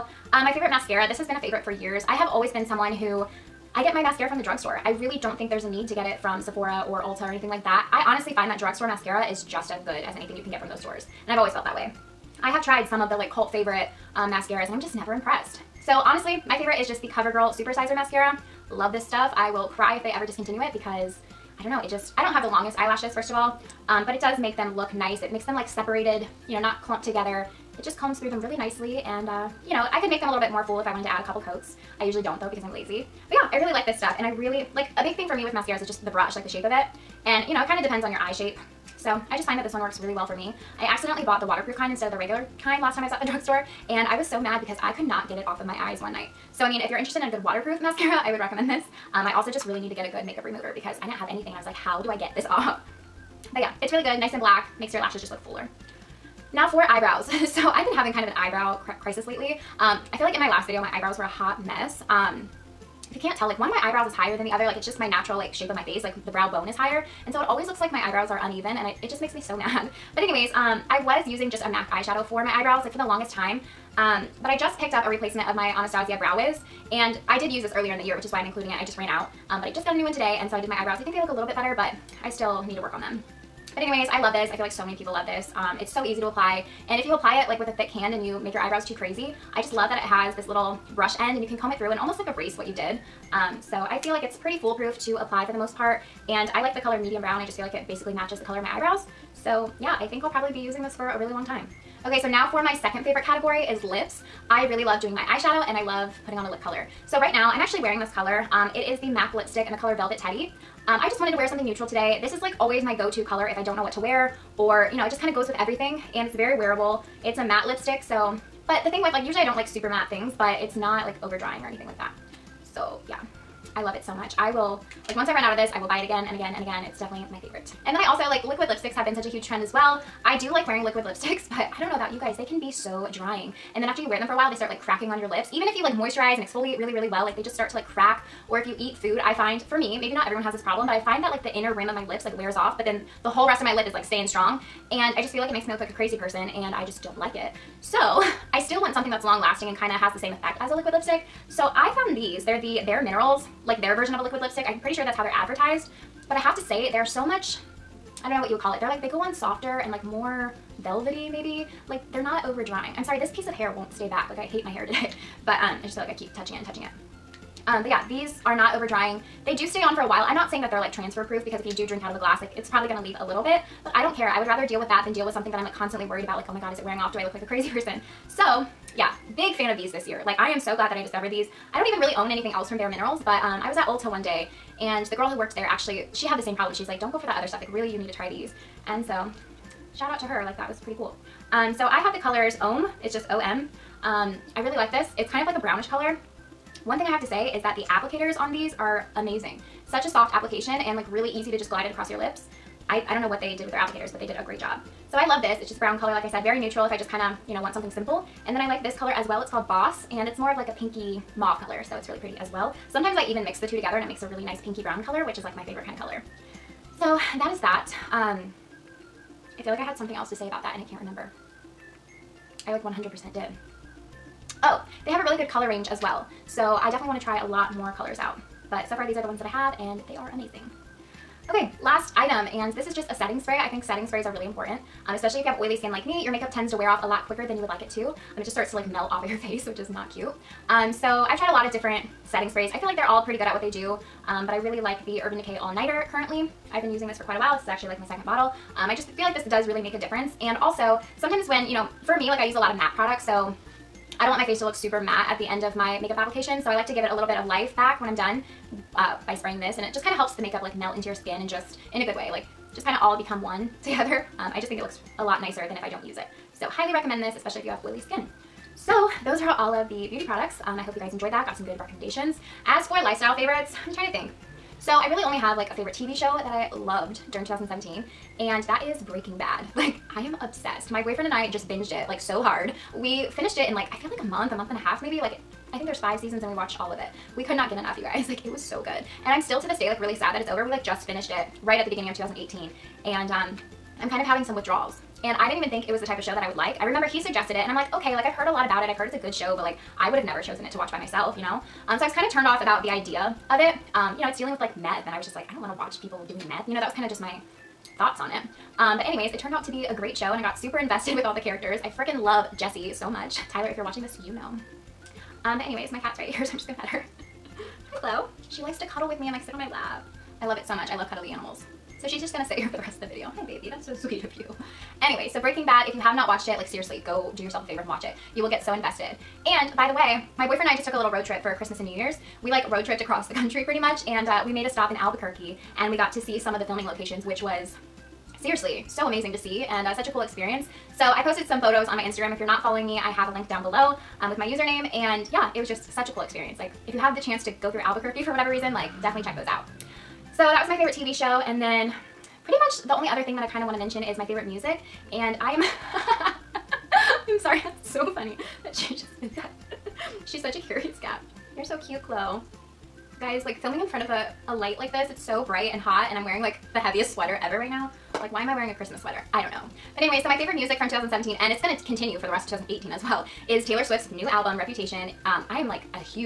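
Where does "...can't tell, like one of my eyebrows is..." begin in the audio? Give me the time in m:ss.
1:03.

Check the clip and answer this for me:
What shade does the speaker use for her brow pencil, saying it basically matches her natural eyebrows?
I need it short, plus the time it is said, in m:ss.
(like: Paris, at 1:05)
medium brown, at 1:36.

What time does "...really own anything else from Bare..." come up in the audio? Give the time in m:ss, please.
3:01.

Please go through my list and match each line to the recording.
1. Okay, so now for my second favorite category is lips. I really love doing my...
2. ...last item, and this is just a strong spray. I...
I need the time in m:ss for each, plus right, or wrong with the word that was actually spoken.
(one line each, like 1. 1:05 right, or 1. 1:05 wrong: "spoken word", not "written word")
1. 1:42 right
2. 3:51 wrong: "setting", not "strong".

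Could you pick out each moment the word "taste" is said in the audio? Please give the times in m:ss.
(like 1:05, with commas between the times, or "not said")
not said.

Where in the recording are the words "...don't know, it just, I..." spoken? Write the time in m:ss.
0:21.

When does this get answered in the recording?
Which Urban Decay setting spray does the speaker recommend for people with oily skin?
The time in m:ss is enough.
4:05.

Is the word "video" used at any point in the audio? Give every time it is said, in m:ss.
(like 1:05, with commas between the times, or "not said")
1:00, 5:23.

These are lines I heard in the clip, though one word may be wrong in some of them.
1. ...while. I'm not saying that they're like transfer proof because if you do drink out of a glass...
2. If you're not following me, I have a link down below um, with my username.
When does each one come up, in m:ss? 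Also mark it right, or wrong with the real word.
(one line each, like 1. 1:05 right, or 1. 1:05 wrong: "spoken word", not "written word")
1. 2:50 right
2. 5:42 right.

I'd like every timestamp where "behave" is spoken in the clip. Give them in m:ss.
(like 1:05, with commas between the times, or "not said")
not said.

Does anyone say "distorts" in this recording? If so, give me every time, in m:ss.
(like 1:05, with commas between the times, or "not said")
not said.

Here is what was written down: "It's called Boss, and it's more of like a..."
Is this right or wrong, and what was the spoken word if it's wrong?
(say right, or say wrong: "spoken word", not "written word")
right.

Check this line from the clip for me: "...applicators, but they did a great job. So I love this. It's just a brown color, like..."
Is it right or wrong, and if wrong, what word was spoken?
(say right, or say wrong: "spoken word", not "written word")
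right.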